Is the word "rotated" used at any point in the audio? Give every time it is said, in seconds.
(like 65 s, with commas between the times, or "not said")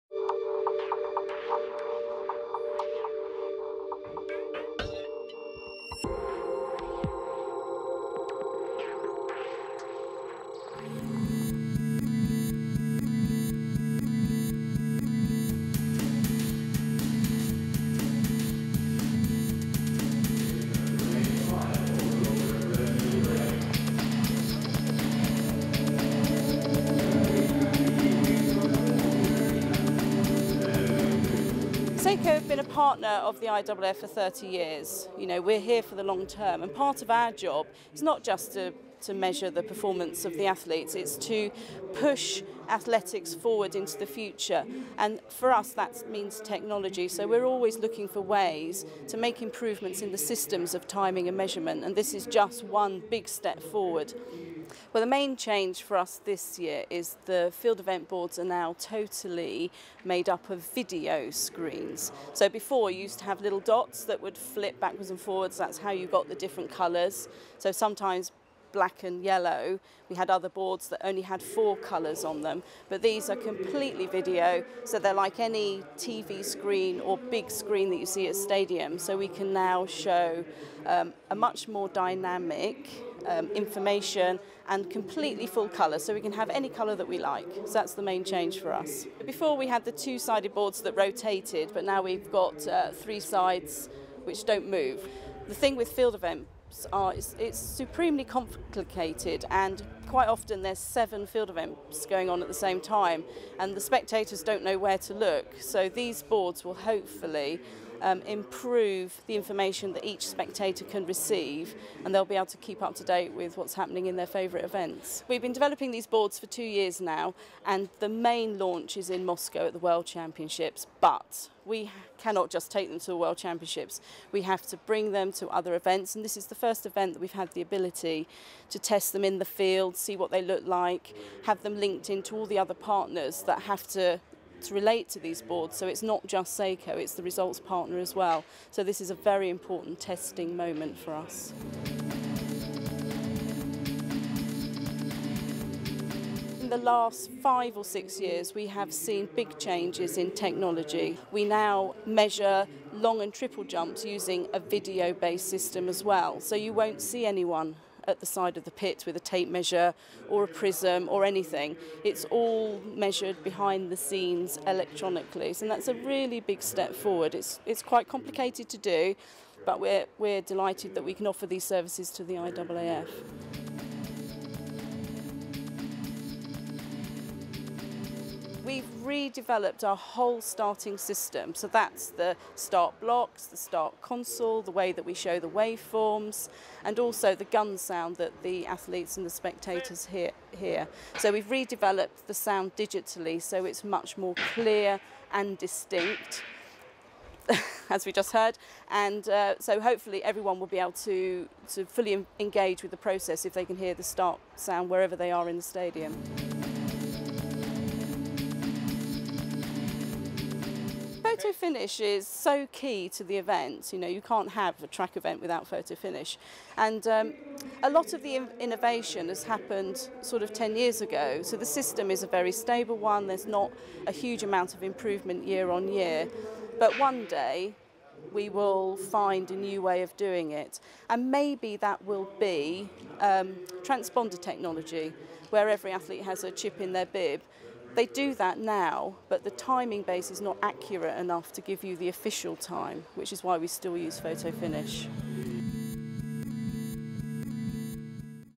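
90 s.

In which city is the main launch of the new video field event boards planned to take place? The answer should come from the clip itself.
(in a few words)
Moscow.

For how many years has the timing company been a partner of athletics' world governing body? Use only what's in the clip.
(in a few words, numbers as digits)
30 years.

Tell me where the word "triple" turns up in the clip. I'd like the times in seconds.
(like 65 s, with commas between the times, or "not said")
153 s.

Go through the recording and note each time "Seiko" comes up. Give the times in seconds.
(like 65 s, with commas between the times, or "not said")
32 s, 136 s.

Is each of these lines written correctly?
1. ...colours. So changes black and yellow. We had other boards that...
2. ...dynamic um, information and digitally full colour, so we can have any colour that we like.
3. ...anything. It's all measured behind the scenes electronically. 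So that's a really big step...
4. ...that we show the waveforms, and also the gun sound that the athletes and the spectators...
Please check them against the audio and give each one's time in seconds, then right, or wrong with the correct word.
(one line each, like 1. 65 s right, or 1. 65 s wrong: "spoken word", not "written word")
1. 66 s wrong: "sometimes", not "changes"
2. 81 s wrong: "completely", not "digitally"
3. 161 s right
4. 184 s right.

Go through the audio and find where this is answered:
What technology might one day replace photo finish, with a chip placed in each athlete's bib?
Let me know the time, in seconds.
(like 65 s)
233 s.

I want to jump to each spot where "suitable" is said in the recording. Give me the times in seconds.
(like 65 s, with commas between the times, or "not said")
not said.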